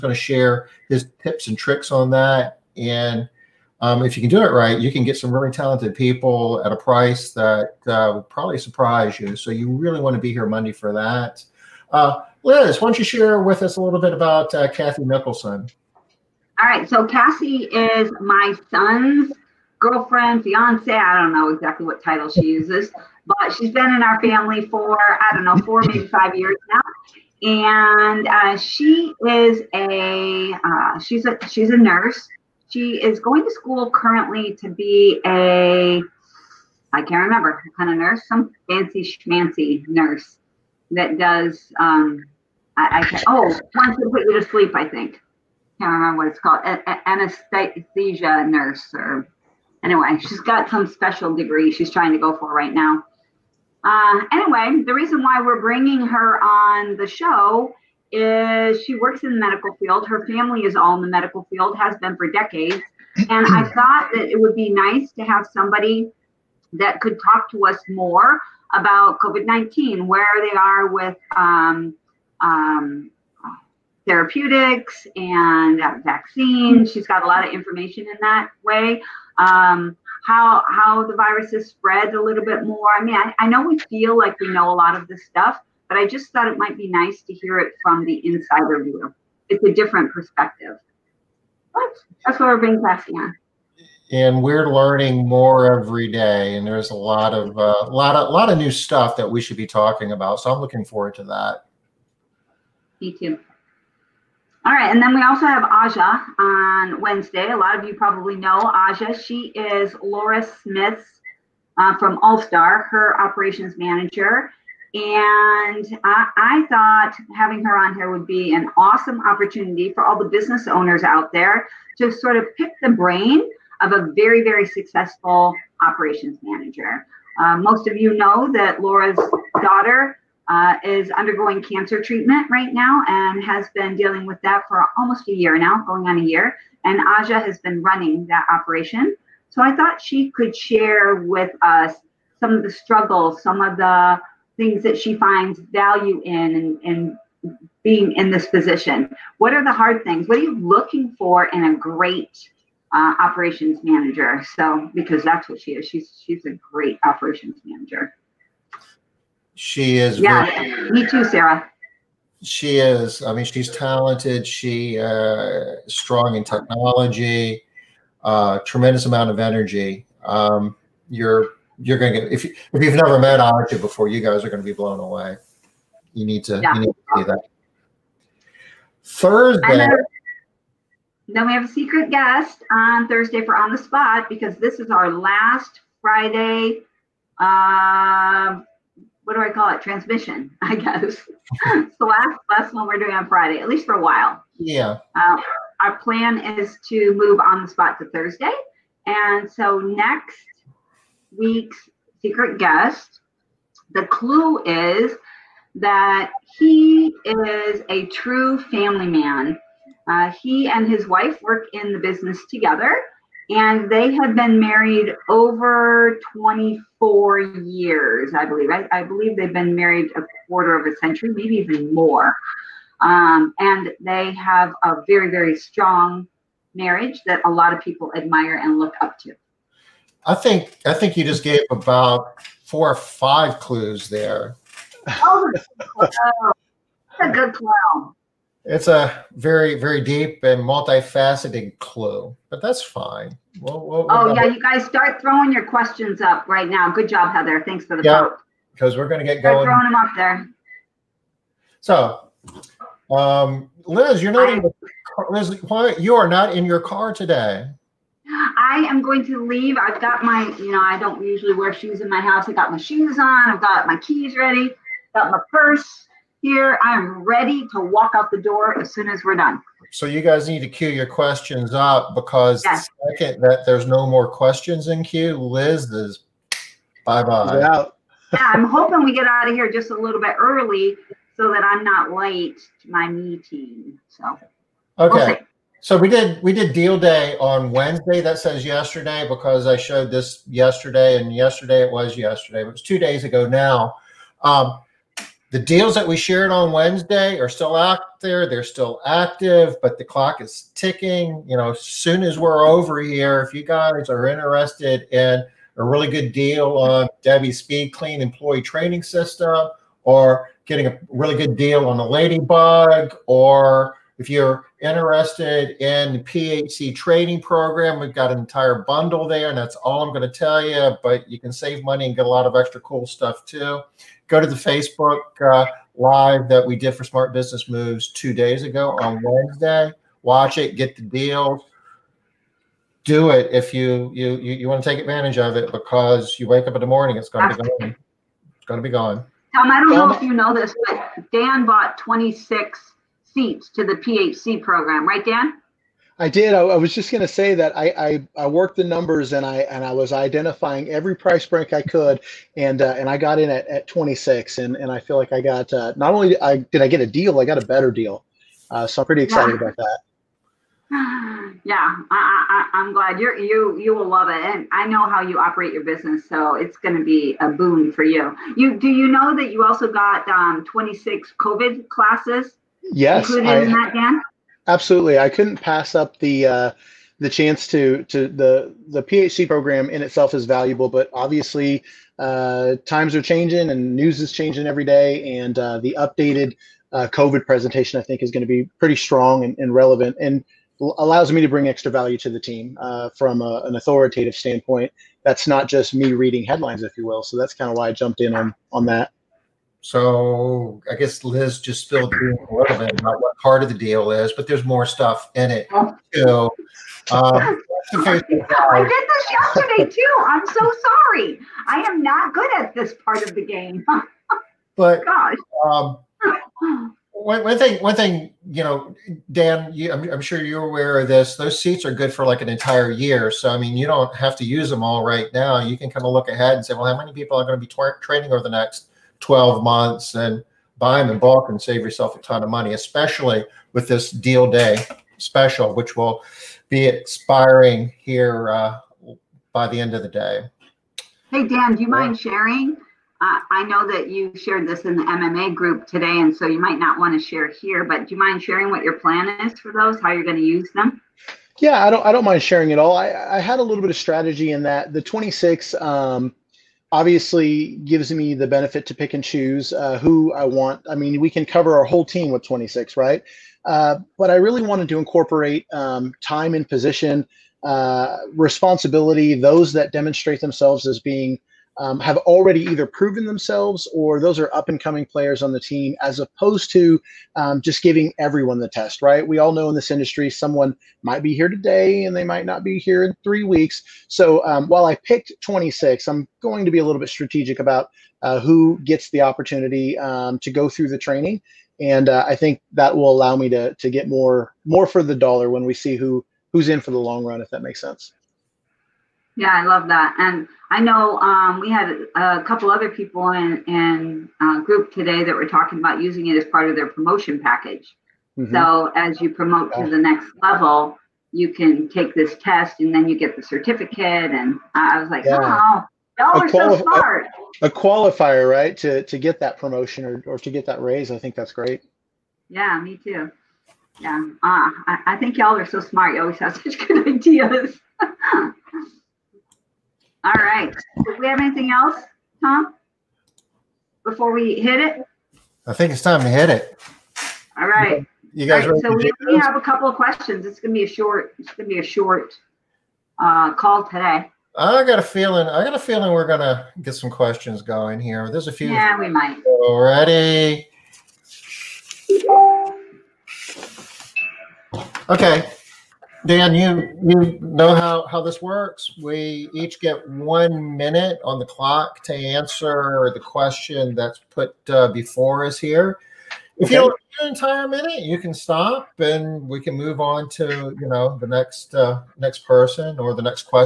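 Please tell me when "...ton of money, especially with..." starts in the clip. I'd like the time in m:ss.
7:12.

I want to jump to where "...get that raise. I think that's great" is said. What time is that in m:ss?
8:40.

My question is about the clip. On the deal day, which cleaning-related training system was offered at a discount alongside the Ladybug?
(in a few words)
Debbie Speed Clean Employee Training System.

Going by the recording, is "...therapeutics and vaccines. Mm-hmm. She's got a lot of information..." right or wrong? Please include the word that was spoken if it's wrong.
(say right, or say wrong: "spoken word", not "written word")
right.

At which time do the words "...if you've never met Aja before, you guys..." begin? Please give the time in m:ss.
2:52.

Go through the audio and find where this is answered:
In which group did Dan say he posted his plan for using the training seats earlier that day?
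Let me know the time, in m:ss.
7:25.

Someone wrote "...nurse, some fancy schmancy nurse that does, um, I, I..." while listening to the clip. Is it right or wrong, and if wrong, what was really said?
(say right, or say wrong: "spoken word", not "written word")
right.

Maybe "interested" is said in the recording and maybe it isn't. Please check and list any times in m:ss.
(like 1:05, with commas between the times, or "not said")
5:04, 5:14.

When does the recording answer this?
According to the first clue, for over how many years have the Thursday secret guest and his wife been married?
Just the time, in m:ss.
3:36.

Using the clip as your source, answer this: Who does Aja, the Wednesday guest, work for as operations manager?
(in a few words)
Laura Smith.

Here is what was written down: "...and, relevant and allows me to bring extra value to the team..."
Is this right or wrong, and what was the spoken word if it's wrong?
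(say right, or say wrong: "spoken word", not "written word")
right.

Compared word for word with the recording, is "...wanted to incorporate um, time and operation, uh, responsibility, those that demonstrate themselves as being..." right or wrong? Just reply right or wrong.
wrong.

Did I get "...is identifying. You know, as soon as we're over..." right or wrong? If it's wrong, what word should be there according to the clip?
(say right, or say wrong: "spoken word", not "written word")
wrong: "ticking", not "identifying".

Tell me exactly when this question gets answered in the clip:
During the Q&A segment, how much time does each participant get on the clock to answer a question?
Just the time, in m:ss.
9:20.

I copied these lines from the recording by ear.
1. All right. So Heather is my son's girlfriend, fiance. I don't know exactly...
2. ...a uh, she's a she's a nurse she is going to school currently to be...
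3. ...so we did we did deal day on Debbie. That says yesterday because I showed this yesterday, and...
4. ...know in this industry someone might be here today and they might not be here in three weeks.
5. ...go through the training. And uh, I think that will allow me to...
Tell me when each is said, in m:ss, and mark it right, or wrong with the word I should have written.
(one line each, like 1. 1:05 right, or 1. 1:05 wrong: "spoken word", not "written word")
1. 0:16 wrong: "Cassie", not "Heather"
2. 0:29 right
3. 4:45 wrong: "Wednesday", not "Debbie"
4. 7:59 right
5. 8:10 right.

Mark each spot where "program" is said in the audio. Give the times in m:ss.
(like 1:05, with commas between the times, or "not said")
5:17, 5:44, 6:19.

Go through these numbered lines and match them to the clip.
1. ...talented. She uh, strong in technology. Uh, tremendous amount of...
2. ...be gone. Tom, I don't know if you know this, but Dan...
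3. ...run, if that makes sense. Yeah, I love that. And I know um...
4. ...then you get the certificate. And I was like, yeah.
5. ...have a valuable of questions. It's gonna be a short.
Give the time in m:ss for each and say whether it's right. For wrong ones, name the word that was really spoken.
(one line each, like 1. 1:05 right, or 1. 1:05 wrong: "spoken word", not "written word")
1. 2:43 right
2. 5:38 right
3. 8:17 right
4. 8:32 right
5. 8:59 wrong: "couple", not "valuable".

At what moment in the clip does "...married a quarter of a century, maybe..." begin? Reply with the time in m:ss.
3:39.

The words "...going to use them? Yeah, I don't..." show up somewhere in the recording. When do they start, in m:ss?
7:30.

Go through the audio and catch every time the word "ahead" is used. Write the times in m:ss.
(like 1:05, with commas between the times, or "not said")
7:06.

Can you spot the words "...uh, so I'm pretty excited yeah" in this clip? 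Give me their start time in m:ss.
5:58.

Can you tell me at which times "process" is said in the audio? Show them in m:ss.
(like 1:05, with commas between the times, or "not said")
not said.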